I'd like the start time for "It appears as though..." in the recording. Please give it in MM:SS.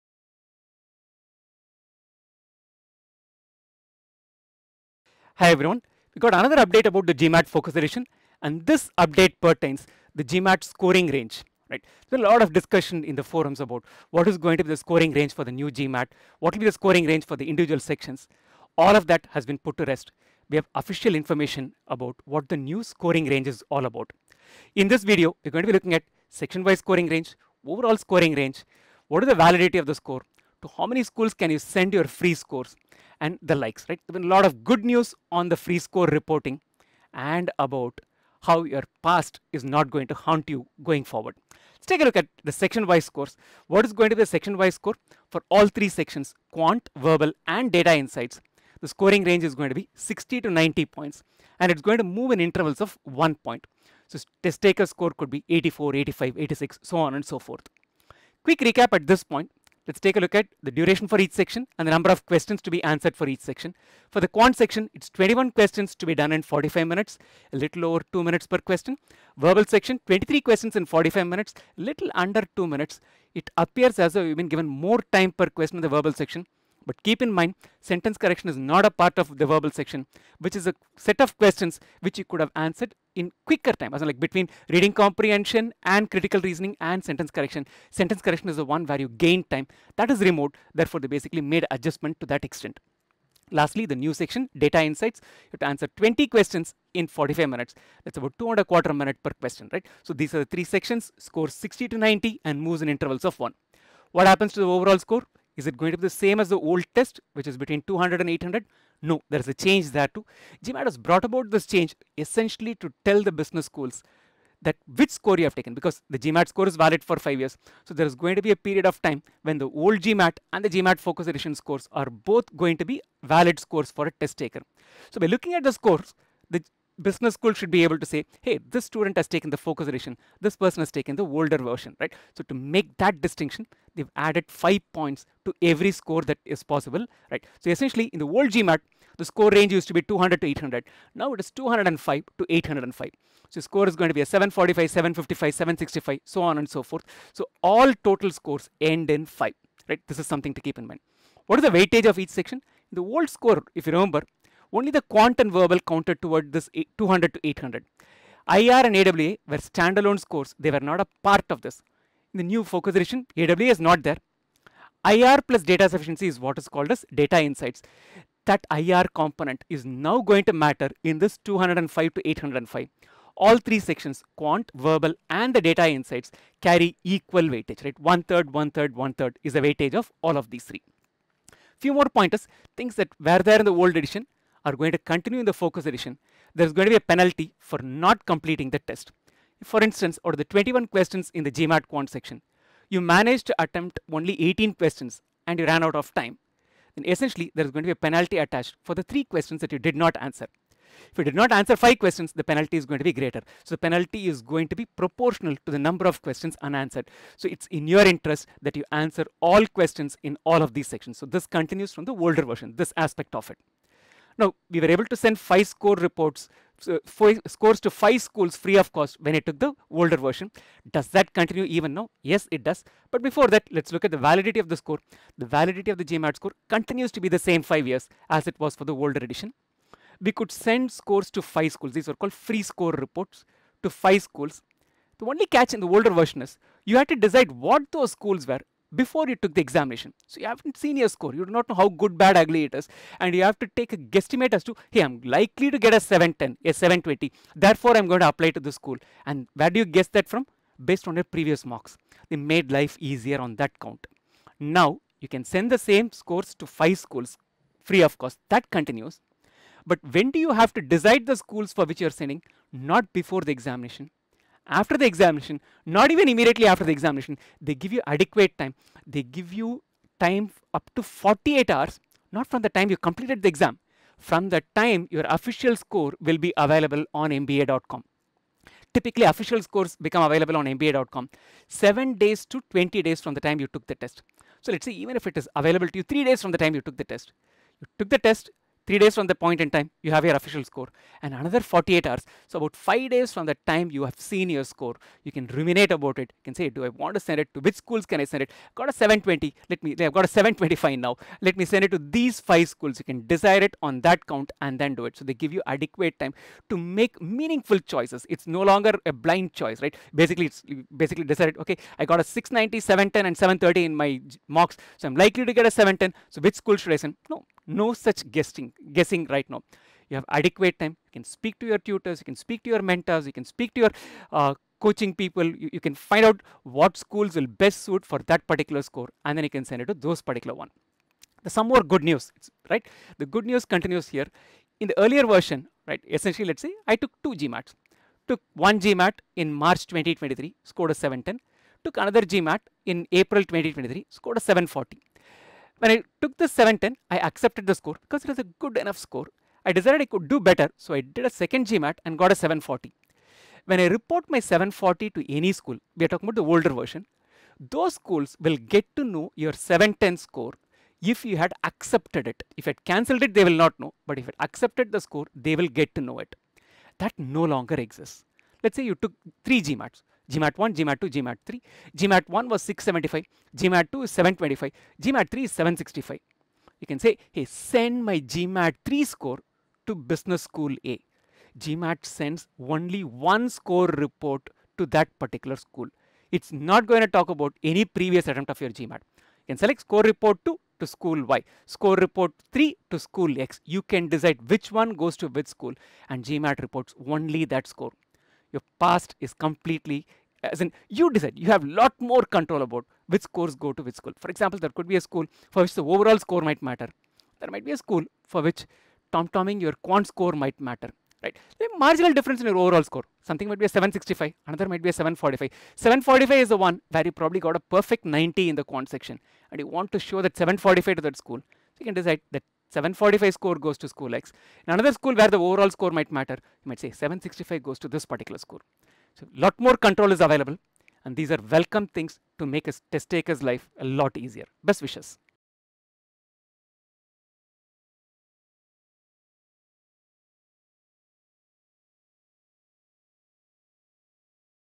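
01:13.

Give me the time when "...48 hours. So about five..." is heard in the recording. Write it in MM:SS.
04:51.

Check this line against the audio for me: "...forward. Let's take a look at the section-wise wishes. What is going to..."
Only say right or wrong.
wrong.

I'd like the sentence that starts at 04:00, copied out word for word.
So you haven't seen your score.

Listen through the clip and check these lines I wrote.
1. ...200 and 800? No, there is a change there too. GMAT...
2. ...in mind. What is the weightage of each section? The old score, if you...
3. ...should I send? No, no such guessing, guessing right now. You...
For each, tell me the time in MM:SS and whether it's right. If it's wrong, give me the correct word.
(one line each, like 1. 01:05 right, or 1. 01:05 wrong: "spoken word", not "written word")
1. 01:47 right
2. 02:30 right
3. 05:16 right.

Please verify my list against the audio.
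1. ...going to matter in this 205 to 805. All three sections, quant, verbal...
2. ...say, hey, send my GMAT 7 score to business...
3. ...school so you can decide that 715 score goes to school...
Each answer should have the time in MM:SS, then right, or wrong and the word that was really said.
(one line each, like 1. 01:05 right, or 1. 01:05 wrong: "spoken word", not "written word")
1. 02:50 right
2. 06:16 wrong: "3", not "7"
3. 07:01 wrong: "745", not "715".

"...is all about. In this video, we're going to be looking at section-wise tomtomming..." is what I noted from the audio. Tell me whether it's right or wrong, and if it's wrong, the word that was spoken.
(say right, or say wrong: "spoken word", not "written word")
wrong: "scoring", not "tomtomming".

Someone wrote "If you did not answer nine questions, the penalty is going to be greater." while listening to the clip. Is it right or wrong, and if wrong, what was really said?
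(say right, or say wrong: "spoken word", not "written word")
wrong: "five", not "nine".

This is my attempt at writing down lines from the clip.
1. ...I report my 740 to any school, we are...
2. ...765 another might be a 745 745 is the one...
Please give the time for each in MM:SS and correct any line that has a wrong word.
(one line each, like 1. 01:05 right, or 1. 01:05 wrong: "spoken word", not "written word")
1. 05:53 right
2. 06:53 right.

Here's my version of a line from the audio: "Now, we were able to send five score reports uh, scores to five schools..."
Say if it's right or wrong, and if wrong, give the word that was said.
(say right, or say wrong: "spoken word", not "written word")
right.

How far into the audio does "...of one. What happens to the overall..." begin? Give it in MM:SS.
01:43.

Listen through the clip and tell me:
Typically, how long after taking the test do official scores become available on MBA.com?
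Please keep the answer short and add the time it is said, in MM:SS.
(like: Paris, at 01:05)
7 to 20 days, at 04:41.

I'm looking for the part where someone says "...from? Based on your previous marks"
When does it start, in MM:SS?
04:10.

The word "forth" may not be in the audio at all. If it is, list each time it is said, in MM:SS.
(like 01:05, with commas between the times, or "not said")
00:57, 02:26.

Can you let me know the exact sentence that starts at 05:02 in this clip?
You can desire it on that count and then do it.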